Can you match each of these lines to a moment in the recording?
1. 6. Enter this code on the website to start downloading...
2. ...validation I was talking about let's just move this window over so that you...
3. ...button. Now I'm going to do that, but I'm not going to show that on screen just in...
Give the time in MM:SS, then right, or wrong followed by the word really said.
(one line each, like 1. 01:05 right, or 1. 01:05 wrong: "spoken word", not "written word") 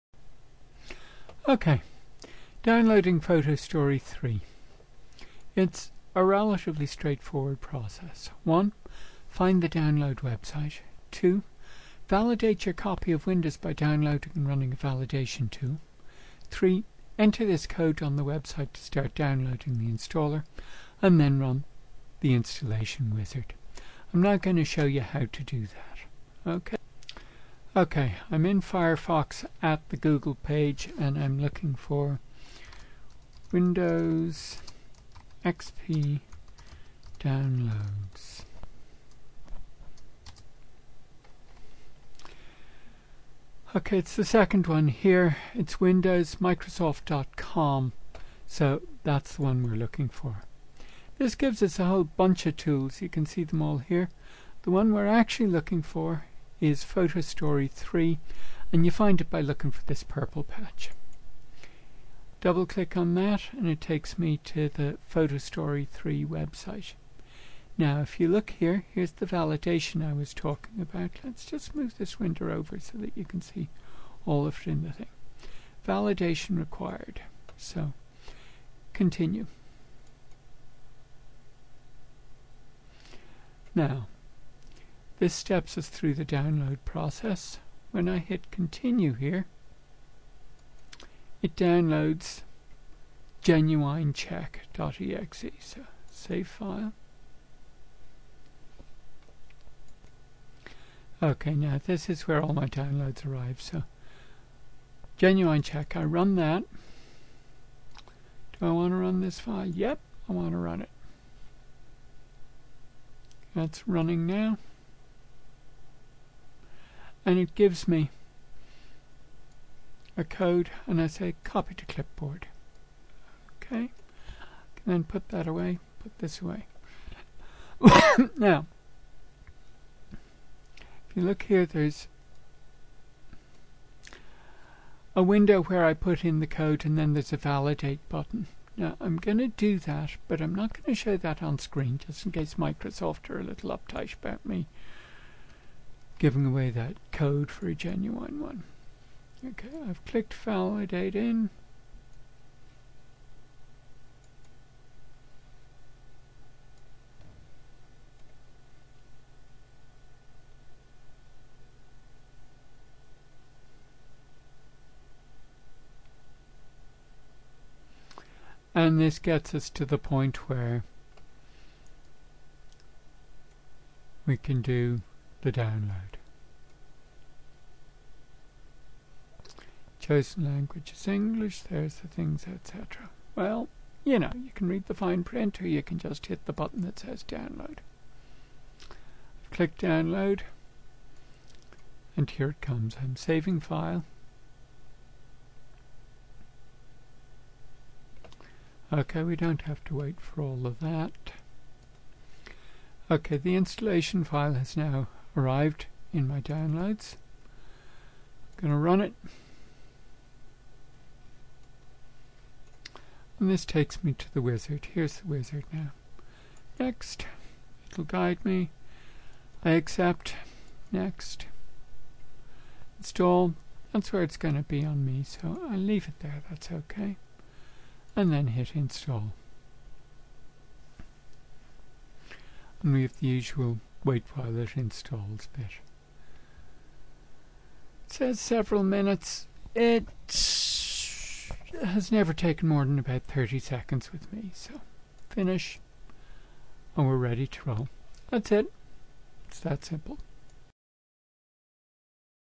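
1. 00:16 wrong: "3", not "6"
2. 01:09 right
3. 02:18 right.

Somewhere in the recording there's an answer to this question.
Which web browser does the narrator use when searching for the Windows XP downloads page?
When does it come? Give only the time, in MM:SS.
00:28.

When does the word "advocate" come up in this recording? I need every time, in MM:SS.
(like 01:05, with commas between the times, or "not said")
not said.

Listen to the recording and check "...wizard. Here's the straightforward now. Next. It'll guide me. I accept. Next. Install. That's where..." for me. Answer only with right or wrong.
wrong.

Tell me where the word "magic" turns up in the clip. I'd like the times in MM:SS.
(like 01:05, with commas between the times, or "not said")
not said.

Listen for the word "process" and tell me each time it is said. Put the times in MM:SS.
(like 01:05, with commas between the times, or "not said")
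00:07, 01:26.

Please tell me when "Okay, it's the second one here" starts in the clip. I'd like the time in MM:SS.
00:43.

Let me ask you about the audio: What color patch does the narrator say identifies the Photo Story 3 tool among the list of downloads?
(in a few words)
Purple.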